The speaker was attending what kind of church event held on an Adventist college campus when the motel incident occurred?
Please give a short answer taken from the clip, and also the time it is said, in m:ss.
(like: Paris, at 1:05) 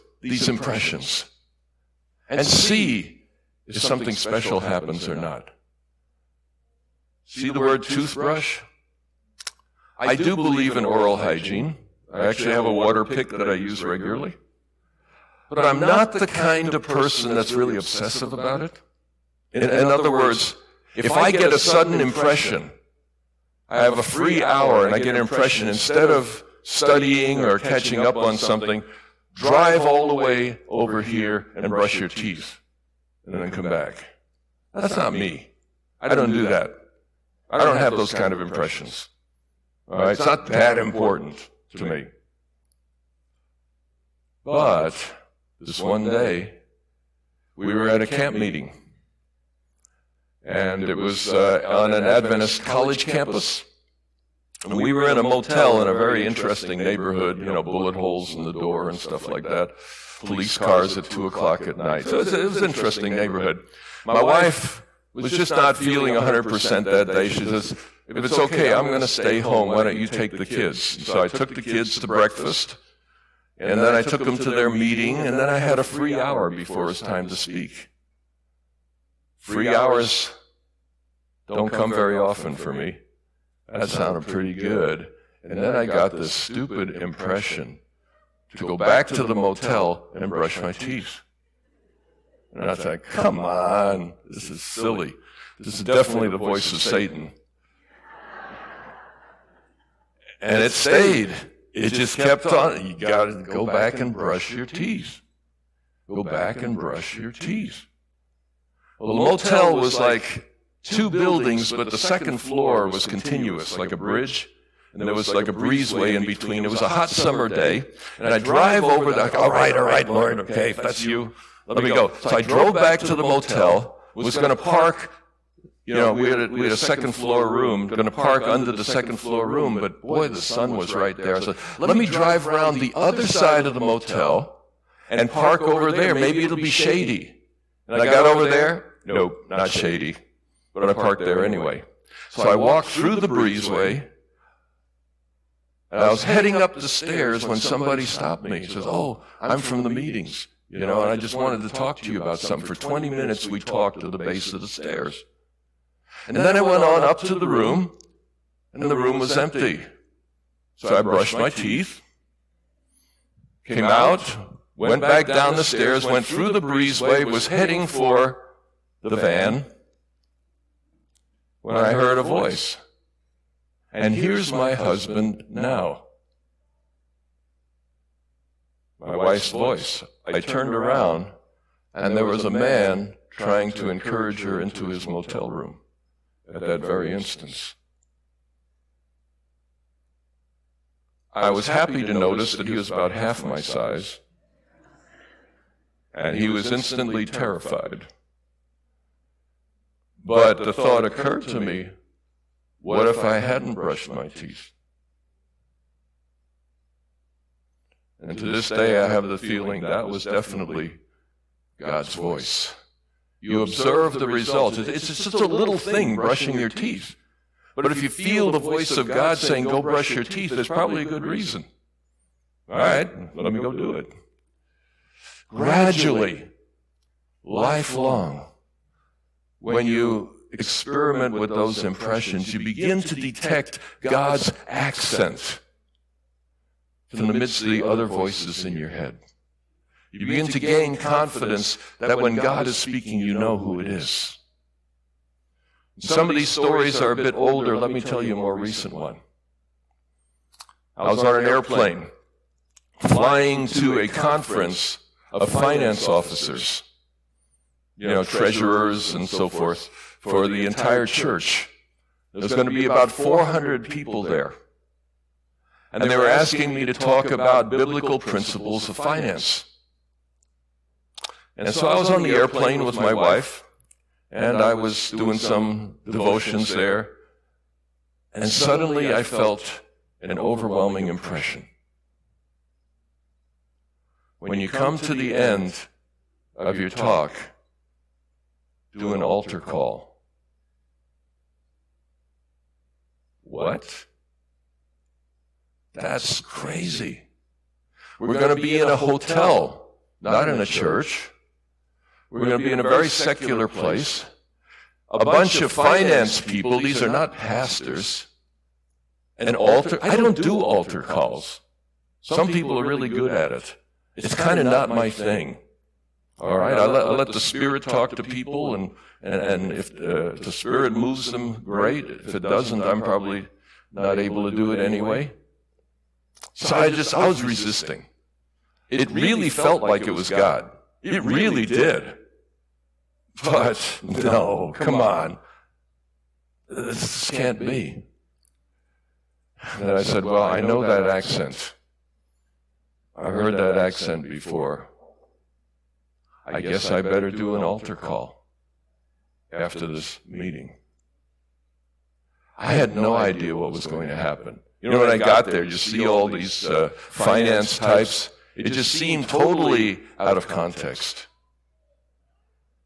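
camp meeting, at 0:48.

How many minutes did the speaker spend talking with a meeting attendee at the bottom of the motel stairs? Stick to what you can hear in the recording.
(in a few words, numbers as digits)
20.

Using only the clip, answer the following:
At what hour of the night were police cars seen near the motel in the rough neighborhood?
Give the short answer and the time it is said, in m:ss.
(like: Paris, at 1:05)
2 o'clock, at 1:01.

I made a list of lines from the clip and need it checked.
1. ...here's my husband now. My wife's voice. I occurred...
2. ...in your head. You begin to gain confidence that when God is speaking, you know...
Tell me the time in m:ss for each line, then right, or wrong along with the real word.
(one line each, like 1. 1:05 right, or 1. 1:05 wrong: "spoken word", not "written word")
1. 2:54 wrong: "turned", not "occurred"
2. 3:58 right.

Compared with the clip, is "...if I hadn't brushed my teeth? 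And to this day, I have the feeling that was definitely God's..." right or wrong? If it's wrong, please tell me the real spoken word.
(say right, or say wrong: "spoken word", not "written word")
right.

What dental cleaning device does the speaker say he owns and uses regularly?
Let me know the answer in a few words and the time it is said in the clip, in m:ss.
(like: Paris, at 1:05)
water pick, at 0:12.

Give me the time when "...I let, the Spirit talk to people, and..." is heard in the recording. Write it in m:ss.
5:17.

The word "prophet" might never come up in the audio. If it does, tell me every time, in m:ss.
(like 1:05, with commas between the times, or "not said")
not said.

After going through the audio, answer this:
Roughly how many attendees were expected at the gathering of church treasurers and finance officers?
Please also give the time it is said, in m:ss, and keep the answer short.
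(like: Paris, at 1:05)
400, at 4:23.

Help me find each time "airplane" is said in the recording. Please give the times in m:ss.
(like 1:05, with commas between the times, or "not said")
4:11, 4:32.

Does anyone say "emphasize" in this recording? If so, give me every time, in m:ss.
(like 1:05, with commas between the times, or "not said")
not said.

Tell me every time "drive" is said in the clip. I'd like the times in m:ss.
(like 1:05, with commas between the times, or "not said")
0:29, 1:58, 2:12.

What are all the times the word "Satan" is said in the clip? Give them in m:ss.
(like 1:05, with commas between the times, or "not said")
1:36.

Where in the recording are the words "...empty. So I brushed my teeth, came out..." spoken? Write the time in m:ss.
2:39.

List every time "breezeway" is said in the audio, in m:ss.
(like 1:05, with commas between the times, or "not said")
1:55, 2:23, 2:46.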